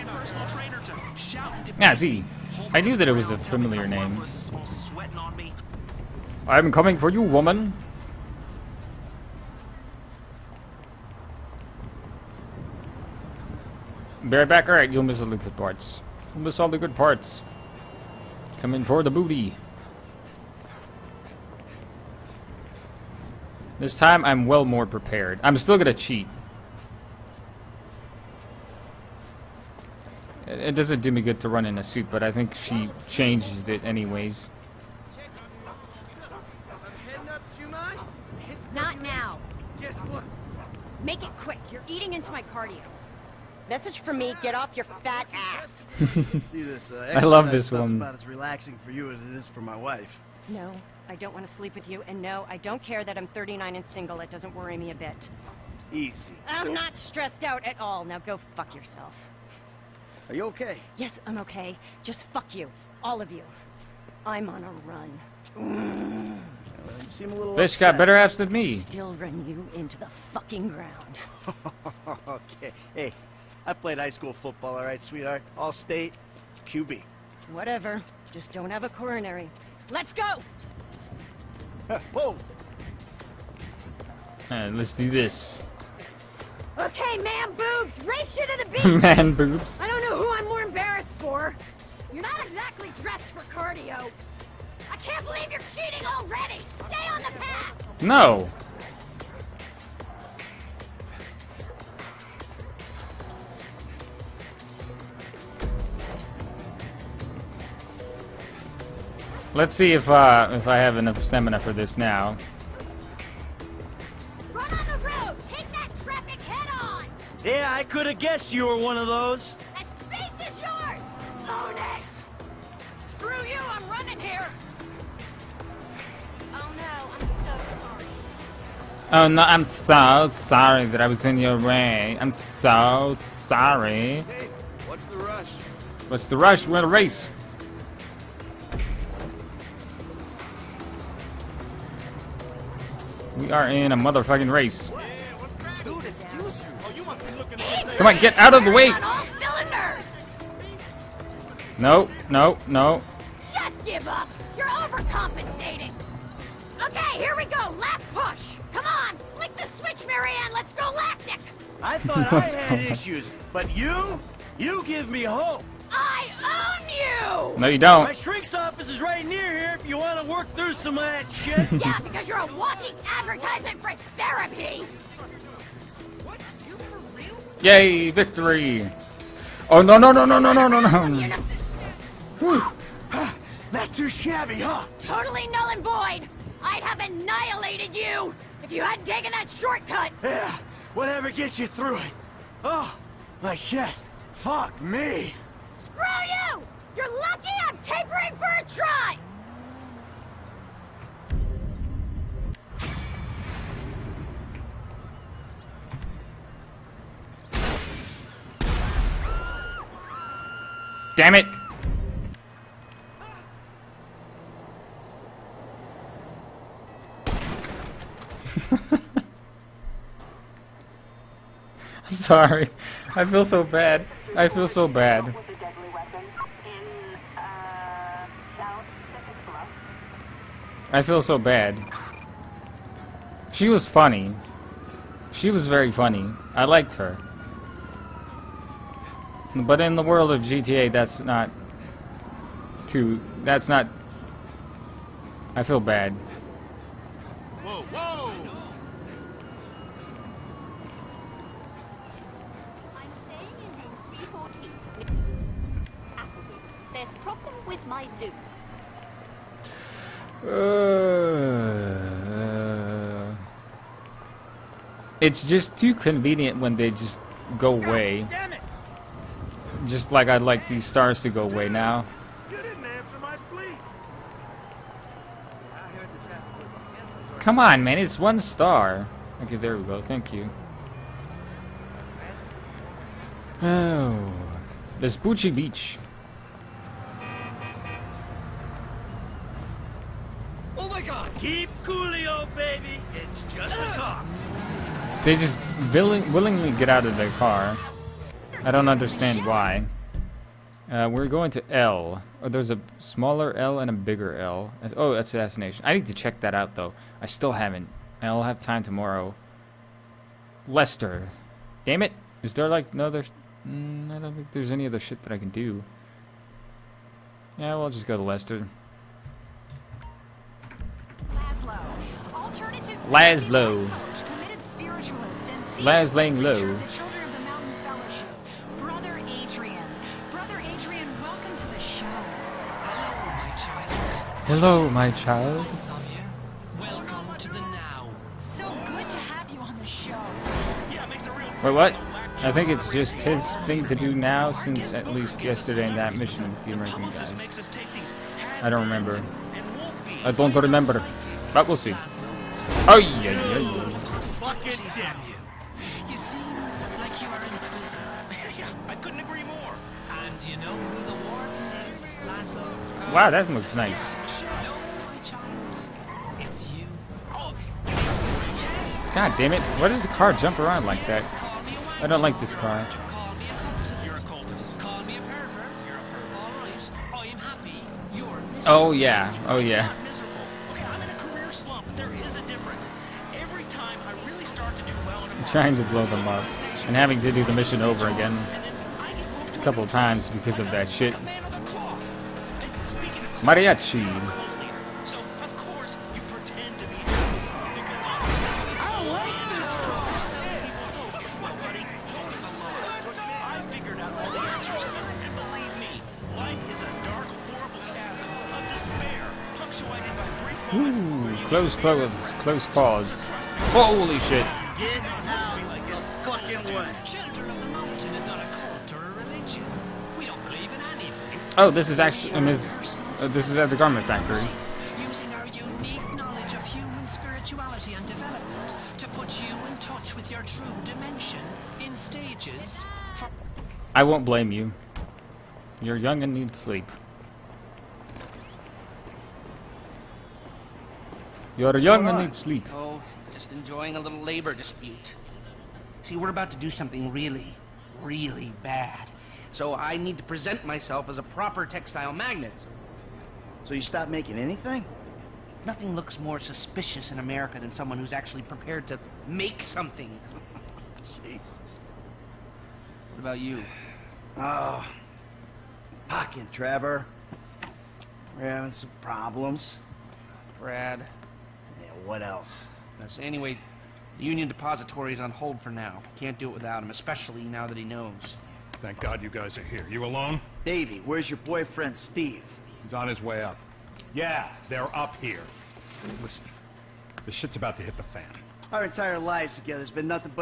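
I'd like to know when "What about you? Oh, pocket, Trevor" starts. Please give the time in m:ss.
7:43.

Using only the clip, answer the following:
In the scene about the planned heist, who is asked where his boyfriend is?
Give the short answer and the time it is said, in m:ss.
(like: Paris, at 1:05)
Davey, at 8:00.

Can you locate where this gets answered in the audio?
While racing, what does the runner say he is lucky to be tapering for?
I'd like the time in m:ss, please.
3:18.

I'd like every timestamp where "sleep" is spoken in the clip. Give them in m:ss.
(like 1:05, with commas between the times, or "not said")
0:51, 7:16, 7:22.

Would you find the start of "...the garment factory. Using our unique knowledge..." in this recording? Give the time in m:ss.
7:03.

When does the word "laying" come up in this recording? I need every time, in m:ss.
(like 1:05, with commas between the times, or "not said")
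5:26.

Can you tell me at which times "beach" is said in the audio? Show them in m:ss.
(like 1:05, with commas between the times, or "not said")
1:28, 4:45.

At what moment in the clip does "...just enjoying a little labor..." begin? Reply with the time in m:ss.
7:23.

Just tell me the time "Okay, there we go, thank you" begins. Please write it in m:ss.
4:39.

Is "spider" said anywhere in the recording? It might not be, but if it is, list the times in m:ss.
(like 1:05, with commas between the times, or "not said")
not said.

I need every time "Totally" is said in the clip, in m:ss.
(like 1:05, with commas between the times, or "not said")
3:04.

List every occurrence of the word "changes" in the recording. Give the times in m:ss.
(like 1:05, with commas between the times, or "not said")
0:33.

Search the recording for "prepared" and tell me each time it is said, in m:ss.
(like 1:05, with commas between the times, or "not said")
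0:24, 7:38.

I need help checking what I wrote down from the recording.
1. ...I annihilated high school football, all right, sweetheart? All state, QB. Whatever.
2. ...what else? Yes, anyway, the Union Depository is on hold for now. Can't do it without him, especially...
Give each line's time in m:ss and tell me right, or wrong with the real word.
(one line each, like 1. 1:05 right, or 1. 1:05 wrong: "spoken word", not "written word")
1. 1:13 wrong: "played", not "annihilated"
2. 7:52 right.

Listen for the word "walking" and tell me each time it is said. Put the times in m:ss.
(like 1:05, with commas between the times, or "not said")
2:52.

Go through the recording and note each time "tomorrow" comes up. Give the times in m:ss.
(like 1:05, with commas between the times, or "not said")
5:08.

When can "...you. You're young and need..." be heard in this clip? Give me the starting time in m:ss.
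7:14.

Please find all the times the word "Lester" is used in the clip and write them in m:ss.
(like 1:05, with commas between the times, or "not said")
5:10, 5:18.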